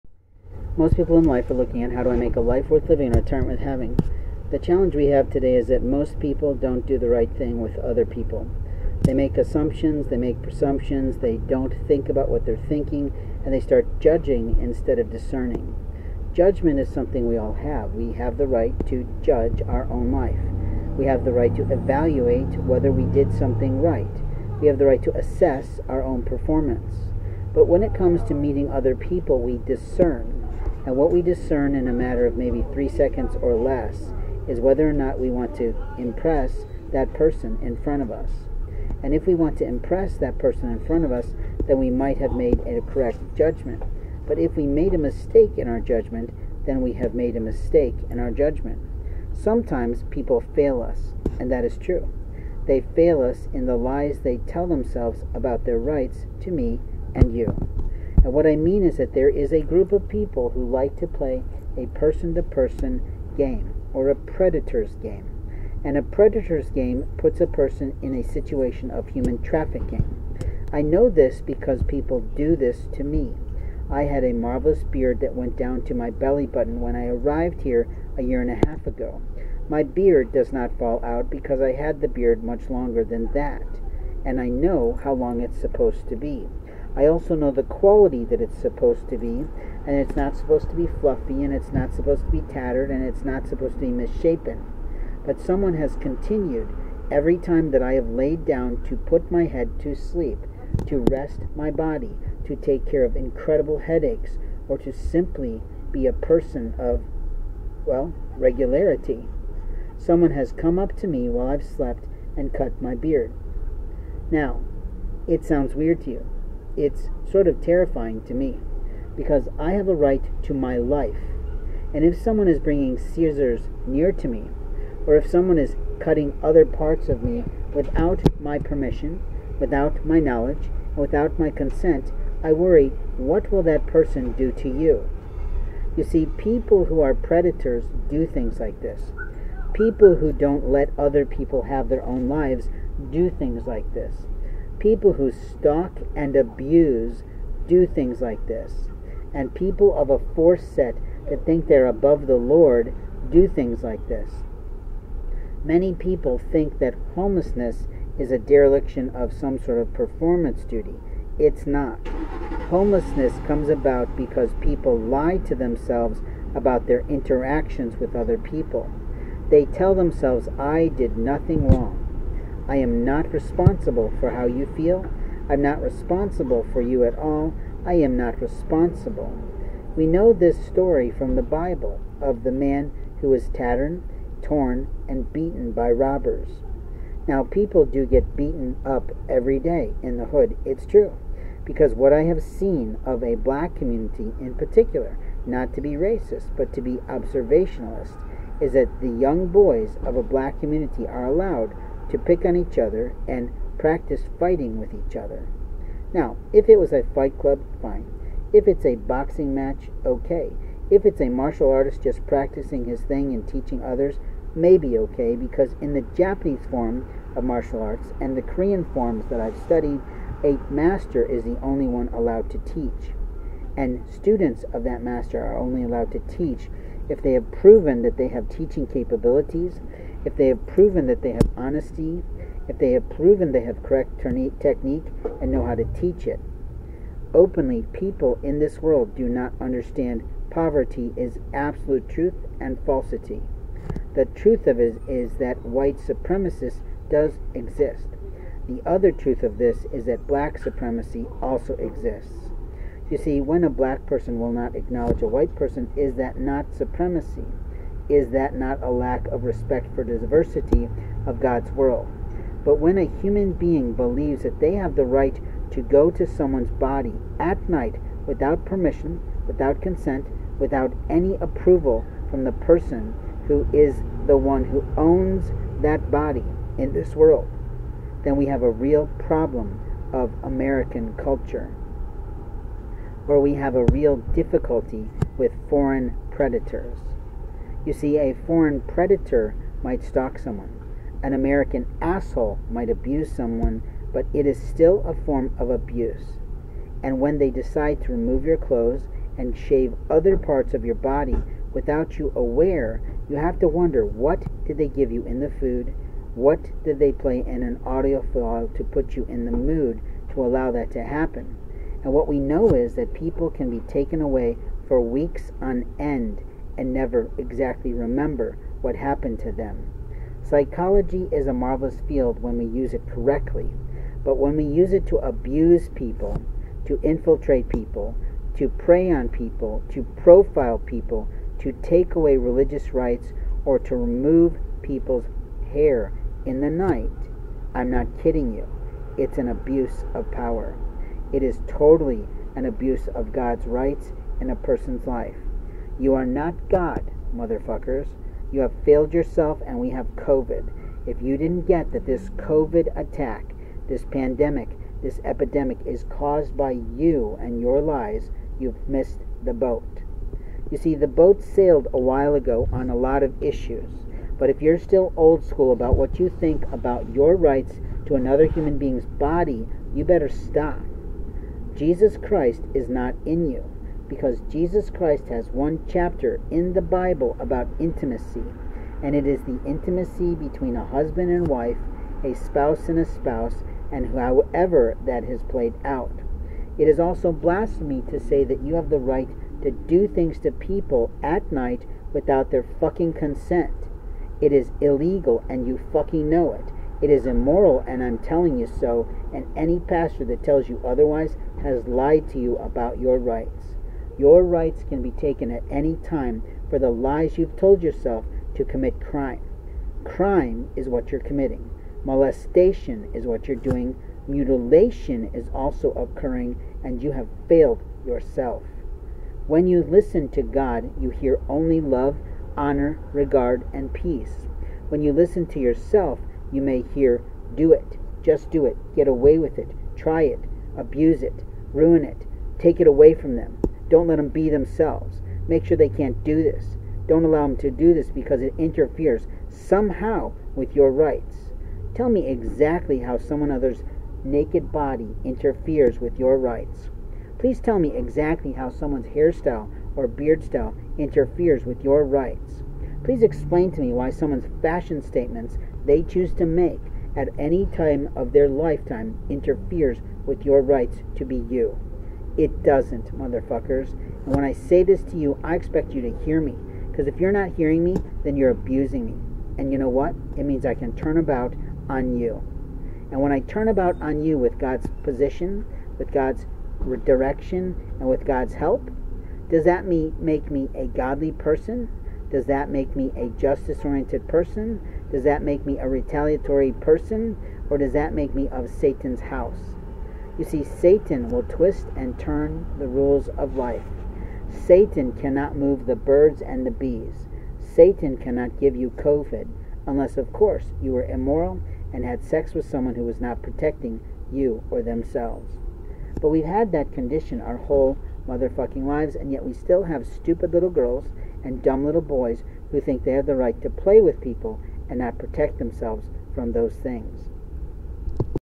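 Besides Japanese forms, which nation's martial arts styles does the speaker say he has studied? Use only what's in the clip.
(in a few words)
Korean.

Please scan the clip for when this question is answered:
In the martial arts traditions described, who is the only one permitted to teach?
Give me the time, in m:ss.
3:40.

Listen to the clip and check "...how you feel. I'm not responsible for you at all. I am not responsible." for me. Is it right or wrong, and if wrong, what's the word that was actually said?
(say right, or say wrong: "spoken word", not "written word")
right.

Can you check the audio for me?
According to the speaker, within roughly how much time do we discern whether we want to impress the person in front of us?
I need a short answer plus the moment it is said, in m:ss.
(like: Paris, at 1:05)
3 seconds, at 0:32.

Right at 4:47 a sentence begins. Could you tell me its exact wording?
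You see, a foreign predator might stalk someone, an American asshole might abuse someone, but it is still a form of abuse.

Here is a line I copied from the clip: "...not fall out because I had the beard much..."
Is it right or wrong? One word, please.
right.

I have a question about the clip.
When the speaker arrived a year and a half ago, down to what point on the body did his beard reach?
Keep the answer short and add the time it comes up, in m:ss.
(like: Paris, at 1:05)
belly button, at 1:16.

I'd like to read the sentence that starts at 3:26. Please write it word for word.
Now, if it was a fight club, fine.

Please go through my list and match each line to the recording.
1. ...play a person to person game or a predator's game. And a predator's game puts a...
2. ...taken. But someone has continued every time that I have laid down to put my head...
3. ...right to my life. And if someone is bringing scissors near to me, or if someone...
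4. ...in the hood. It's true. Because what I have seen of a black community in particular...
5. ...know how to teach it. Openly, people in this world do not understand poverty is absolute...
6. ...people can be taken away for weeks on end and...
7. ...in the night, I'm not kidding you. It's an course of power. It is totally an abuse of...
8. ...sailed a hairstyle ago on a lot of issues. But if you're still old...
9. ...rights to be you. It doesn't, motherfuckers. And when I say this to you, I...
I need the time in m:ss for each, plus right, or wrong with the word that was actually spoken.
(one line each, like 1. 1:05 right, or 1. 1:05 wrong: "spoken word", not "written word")
1. 1:01 right
2. 1:33 wrong: "misshapen", not "taken"
3. 1:59 right
4. 3:10 right
5. 3:55 right
6. 5:13 right
7. 5:36 wrong: "abuse", not "course"
8. 6:01 wrong: "while", not "hairstyle"
9. 7:40 right.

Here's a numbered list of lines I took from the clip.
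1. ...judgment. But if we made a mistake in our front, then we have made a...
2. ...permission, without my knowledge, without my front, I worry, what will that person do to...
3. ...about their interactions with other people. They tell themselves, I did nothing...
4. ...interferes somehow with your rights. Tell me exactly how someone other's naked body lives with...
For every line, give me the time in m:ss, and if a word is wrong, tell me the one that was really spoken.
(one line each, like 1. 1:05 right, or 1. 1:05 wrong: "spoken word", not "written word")
1. 0:43 wrong: "judgment", not "front"
2. 2:08 wrong: "consent", not "front"
3. 2:46 right
4. 7:18 wrong: "interferes", not "lives".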